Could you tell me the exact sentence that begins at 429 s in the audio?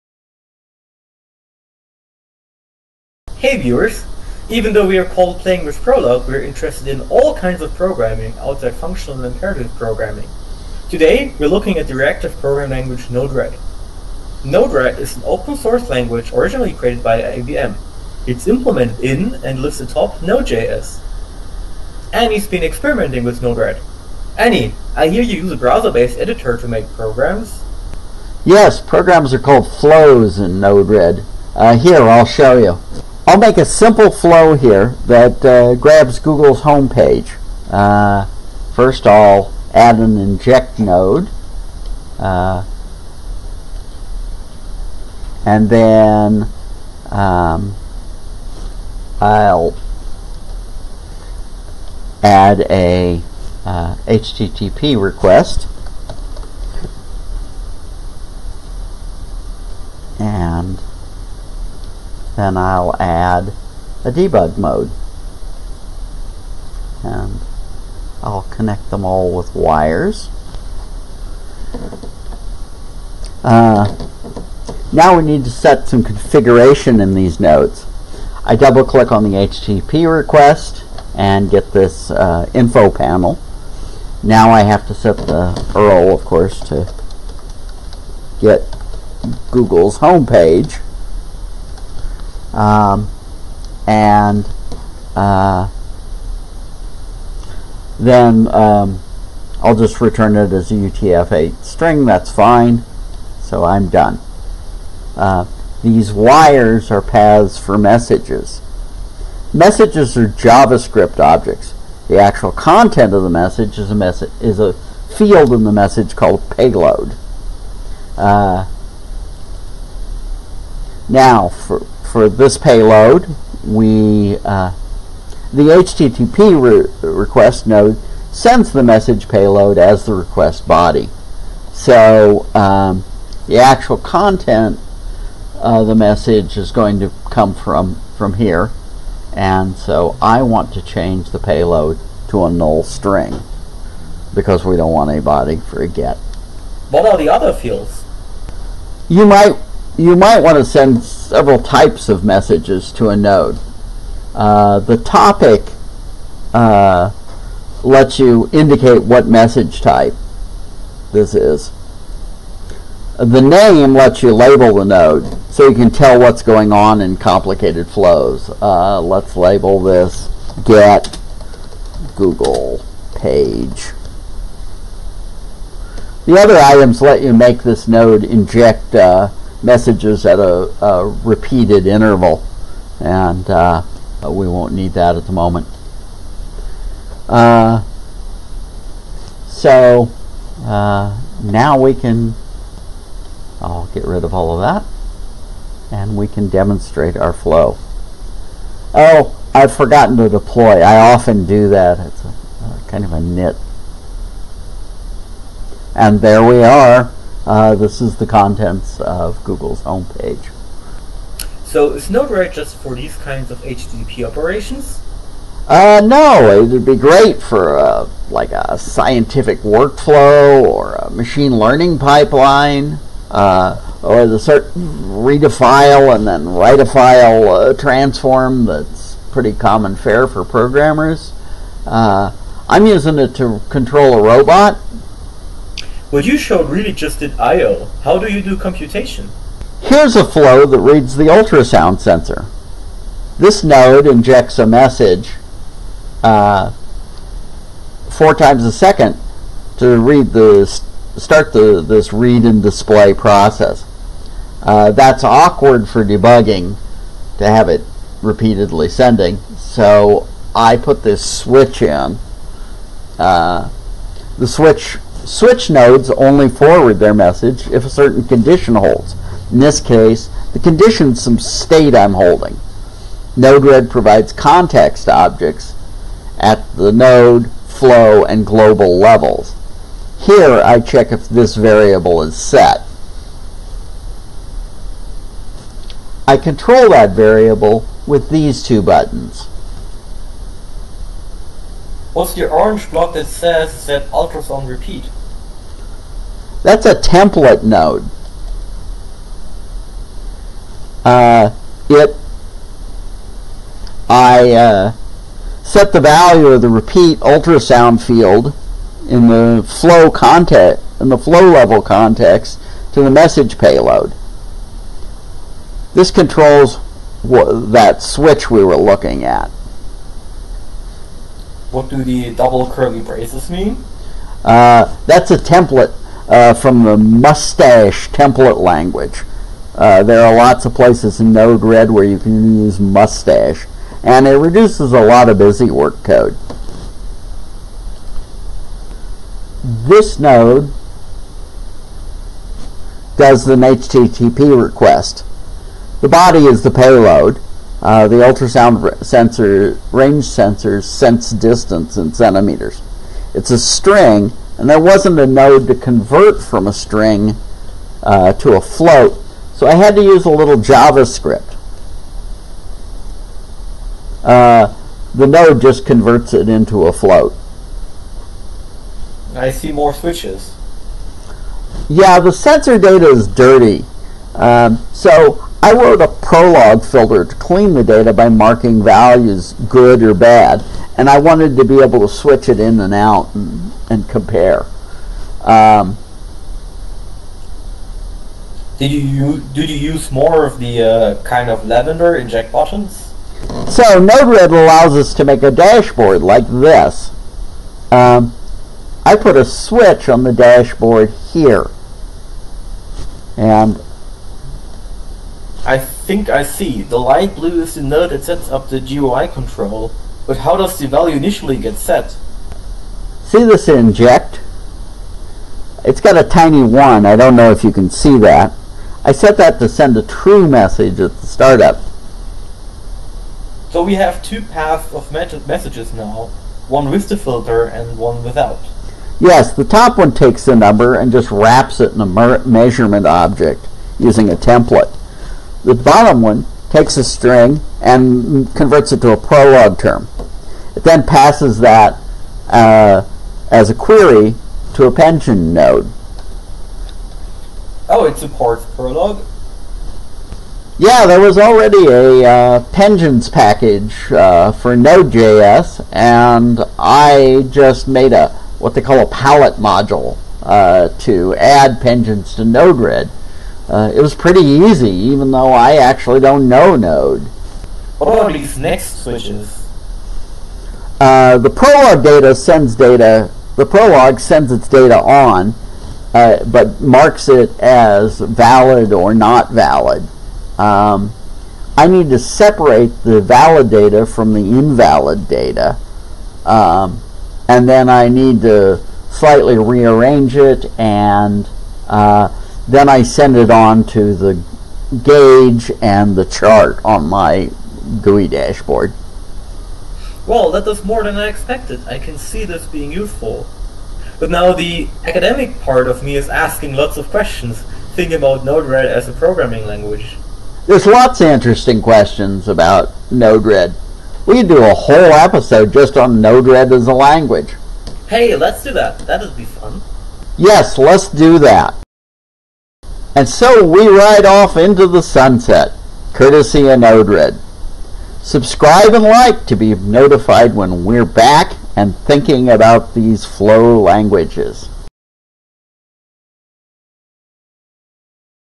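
Yes, the top one takes the number and just wraps it in a measurement object using a template.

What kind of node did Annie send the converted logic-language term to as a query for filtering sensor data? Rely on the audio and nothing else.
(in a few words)
pengine node.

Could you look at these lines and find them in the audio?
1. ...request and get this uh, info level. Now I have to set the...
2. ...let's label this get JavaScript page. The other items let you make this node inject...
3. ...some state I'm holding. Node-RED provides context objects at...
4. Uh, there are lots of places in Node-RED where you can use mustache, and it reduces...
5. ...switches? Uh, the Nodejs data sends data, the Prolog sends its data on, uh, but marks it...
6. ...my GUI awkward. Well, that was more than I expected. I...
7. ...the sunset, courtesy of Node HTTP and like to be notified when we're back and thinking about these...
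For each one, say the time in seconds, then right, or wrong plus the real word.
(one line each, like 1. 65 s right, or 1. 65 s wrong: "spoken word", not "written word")
1. 80 s wrong: "panel", not "level"
2. 168 s wrong: "Google", not "JavaScript"
3. 271 s right
4. 329 s right
5. 469 s wrong: "Prolog", not "Nodejs"
6. 497 s wrong: "dashboard", not "awkward"
7. 524 s wrong: "Subscribe", not "HTTP".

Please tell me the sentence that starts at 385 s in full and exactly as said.
Um, did you do you use more of the uh, kind of lavender inject buttons?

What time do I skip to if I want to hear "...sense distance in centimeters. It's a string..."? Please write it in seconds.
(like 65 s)
350 s.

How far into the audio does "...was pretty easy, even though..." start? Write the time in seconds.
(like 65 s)
464 s.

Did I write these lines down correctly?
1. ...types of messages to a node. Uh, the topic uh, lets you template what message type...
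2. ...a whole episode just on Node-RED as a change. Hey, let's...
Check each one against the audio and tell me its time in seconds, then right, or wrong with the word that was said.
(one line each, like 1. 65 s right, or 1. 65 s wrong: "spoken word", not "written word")
1. 151 s wrong: "indicate", not "template"
2. 514 s wrong: "language", not "change".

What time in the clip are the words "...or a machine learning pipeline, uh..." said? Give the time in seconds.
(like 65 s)
220 s.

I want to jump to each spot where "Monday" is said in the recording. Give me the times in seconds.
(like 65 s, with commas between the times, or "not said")
not said.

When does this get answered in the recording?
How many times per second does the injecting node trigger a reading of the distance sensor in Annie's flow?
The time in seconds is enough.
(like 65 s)
248 s.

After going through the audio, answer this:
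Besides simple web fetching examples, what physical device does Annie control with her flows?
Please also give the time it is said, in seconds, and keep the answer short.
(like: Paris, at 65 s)
a robot, at 234 s.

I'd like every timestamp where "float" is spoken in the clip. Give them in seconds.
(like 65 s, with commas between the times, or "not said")
358 s, 366 s.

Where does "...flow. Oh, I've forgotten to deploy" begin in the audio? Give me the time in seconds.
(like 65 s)
197 s.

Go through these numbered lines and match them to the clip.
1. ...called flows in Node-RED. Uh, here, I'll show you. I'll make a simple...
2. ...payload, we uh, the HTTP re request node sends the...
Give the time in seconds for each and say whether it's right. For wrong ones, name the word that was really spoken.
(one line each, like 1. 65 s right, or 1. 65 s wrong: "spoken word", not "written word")
1. 29 s right
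2. 122 s right.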